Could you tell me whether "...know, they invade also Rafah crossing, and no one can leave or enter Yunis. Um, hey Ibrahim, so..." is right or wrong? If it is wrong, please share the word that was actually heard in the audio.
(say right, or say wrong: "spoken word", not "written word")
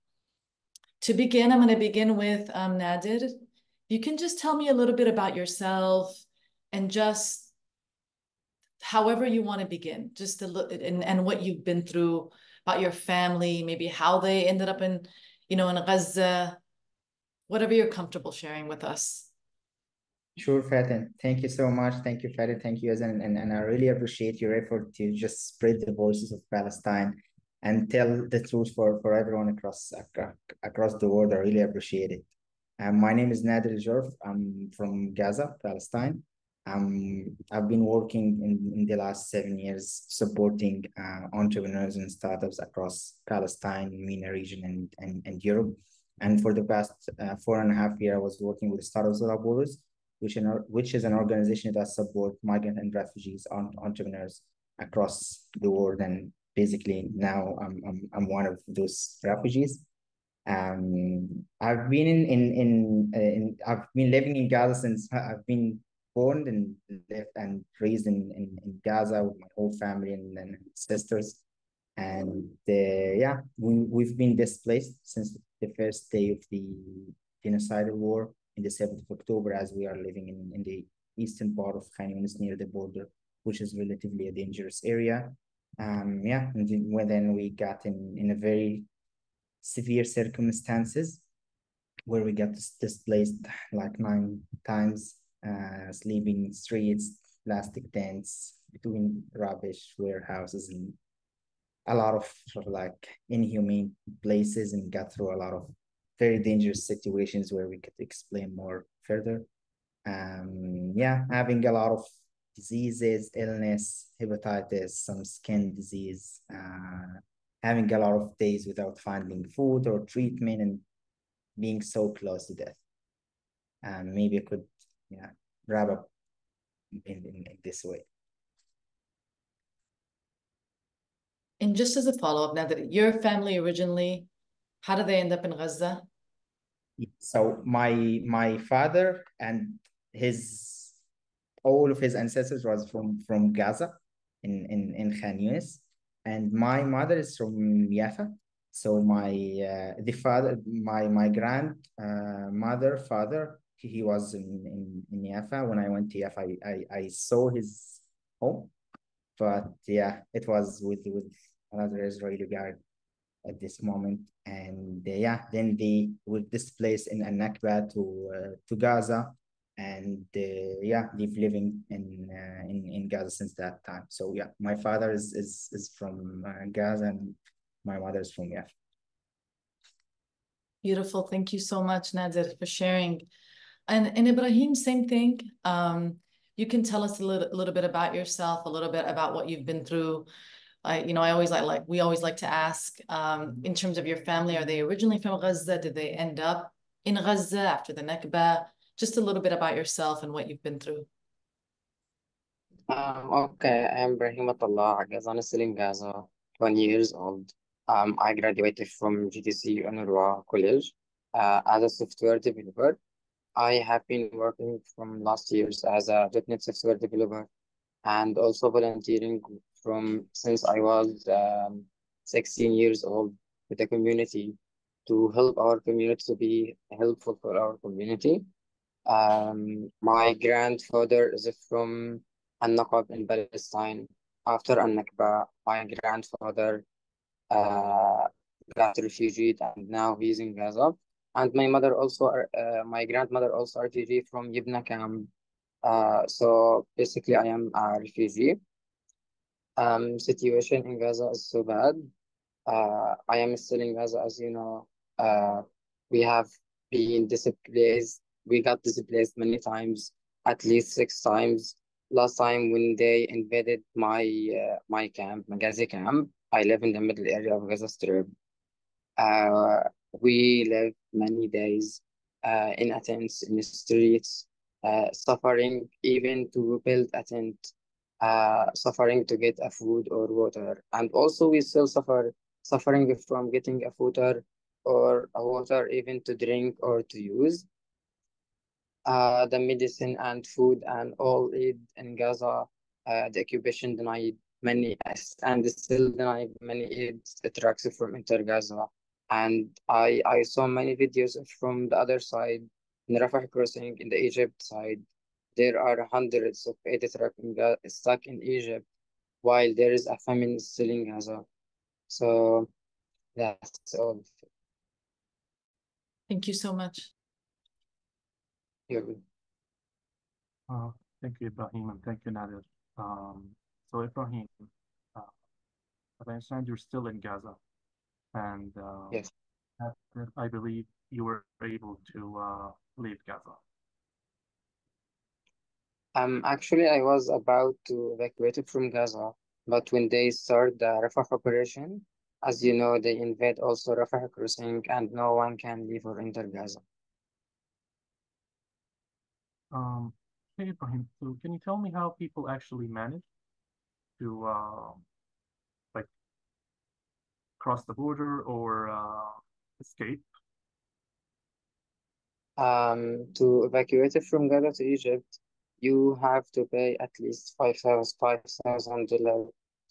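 wrong: "Gaza", not "Yunis".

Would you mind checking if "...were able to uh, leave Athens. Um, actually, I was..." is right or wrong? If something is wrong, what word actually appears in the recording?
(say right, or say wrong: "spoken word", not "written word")
wrong: "Gaza", not "Athens".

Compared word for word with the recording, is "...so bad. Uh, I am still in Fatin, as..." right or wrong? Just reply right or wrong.
wrong.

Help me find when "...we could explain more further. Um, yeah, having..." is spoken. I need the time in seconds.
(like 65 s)
107 s.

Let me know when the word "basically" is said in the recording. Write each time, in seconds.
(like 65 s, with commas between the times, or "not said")
56 s, 246 s.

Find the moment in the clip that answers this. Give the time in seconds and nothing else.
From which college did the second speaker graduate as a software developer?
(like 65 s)
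209 s.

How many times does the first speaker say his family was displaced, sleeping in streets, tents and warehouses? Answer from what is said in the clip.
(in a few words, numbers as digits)
9.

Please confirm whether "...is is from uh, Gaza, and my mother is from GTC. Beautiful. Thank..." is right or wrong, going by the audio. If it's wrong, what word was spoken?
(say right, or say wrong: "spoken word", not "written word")
wrong: "Yafa", not "GTC".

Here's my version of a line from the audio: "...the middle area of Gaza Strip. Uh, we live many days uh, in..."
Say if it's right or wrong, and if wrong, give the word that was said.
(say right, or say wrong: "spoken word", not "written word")
right.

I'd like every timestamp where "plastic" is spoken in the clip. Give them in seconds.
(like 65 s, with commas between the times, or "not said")
97 s.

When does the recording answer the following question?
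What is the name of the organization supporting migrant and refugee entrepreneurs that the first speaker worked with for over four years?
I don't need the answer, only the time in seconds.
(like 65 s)
48 s.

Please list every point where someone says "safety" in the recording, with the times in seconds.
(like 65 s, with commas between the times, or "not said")
not said.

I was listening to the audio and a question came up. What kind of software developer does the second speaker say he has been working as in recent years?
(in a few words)
.NET.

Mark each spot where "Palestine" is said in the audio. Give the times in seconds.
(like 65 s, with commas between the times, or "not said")
26 s, 35 s, 43 s, 233 s.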